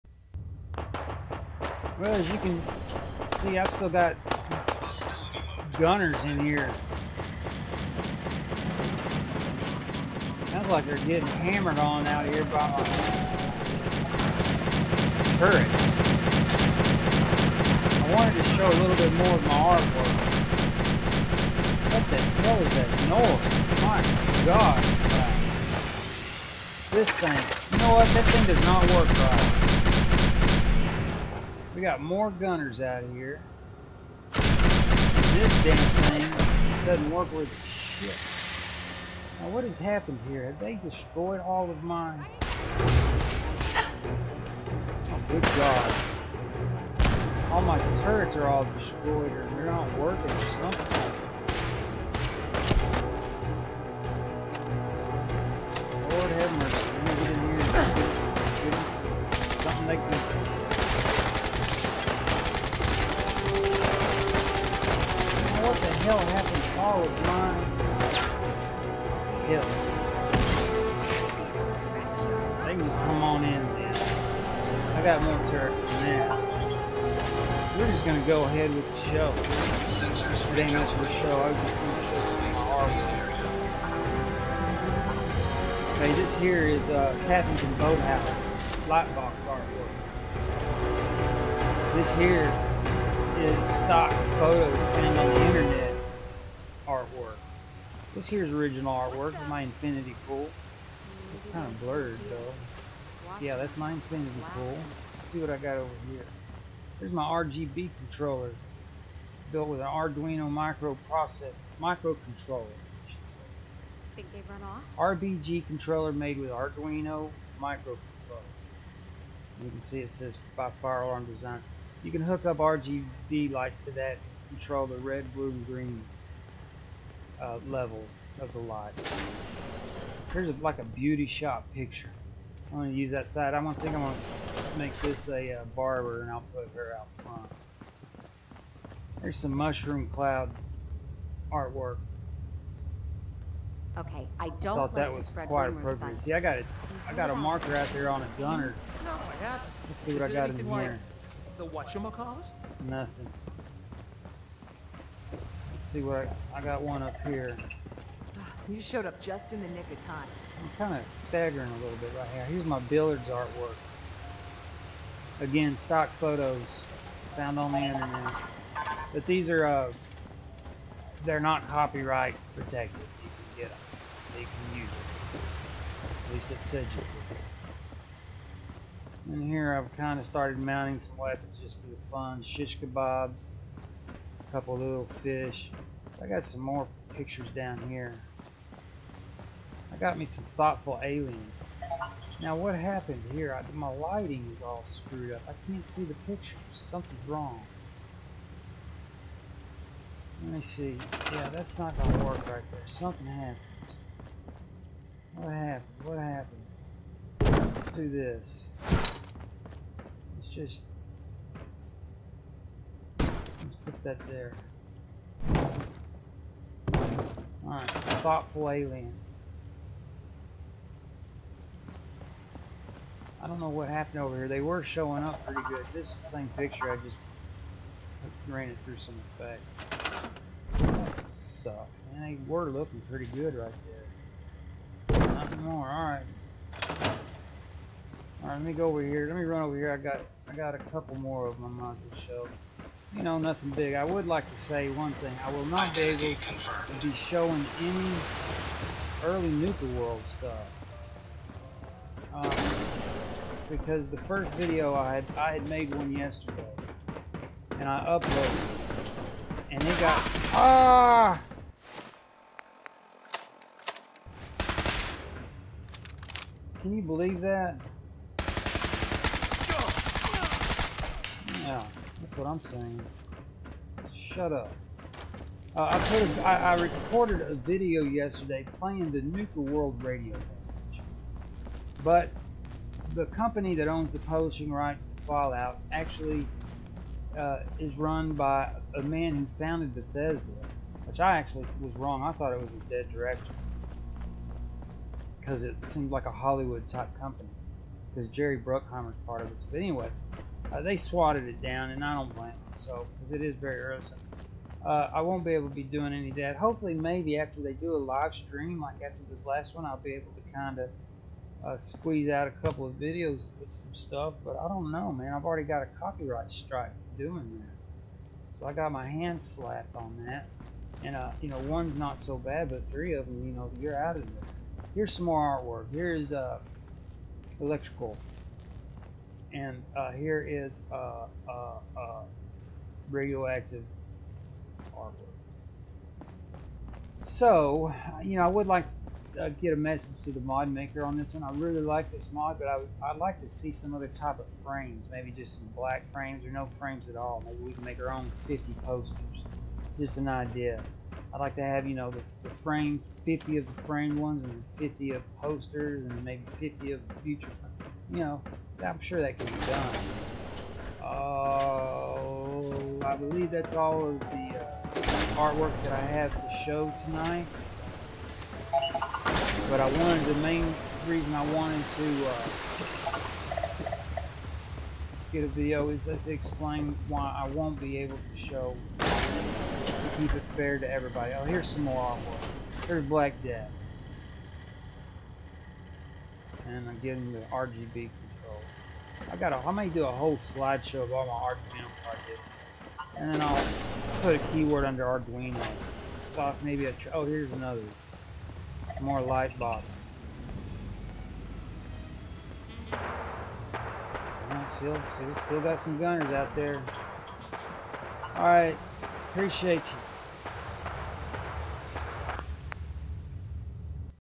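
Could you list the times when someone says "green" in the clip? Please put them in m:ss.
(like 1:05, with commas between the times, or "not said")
2:05.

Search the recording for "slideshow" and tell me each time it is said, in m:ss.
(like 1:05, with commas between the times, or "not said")
6:30.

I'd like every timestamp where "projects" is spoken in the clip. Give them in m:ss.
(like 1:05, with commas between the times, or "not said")
6:32.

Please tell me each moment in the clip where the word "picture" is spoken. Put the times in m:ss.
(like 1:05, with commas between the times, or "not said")
2:11, 3:07, 3:16, 3:46.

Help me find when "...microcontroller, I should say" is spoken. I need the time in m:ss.
1:51.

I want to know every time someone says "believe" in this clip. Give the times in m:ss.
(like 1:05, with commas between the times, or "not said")
4:27, 6:03.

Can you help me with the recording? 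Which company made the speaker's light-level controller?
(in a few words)
Firearm Design.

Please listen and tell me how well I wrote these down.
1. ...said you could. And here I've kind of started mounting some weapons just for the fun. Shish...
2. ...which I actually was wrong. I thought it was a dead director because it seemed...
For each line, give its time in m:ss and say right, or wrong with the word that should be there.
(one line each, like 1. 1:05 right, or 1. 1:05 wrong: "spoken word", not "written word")
1. 2:56 right
2. 4:51 right.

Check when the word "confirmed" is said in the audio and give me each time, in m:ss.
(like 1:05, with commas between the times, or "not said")
4:06.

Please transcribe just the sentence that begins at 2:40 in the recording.
I'm kind of staggering a little bit right here.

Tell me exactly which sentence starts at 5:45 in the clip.
Maybe just some black frames or no frames at all.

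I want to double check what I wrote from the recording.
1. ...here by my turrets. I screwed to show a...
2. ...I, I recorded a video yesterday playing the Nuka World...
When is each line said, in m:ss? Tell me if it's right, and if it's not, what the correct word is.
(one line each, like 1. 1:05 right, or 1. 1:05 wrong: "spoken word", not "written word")
1. 0:12 wrong: "wanted", not "screwed"
2. 4:36 right.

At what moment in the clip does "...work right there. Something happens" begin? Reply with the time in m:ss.
3:22.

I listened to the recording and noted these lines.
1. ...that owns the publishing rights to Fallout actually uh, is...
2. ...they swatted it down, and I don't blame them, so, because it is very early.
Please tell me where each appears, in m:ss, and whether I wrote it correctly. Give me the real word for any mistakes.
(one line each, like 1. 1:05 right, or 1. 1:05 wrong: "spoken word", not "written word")
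1. 4:43 right
2. 5:00 right.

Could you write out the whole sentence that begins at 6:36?
So maybe a, oh here's another, some more light box.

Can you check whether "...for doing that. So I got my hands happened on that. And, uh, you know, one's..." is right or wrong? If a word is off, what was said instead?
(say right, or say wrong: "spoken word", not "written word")
wrong: "slapped", not "happened".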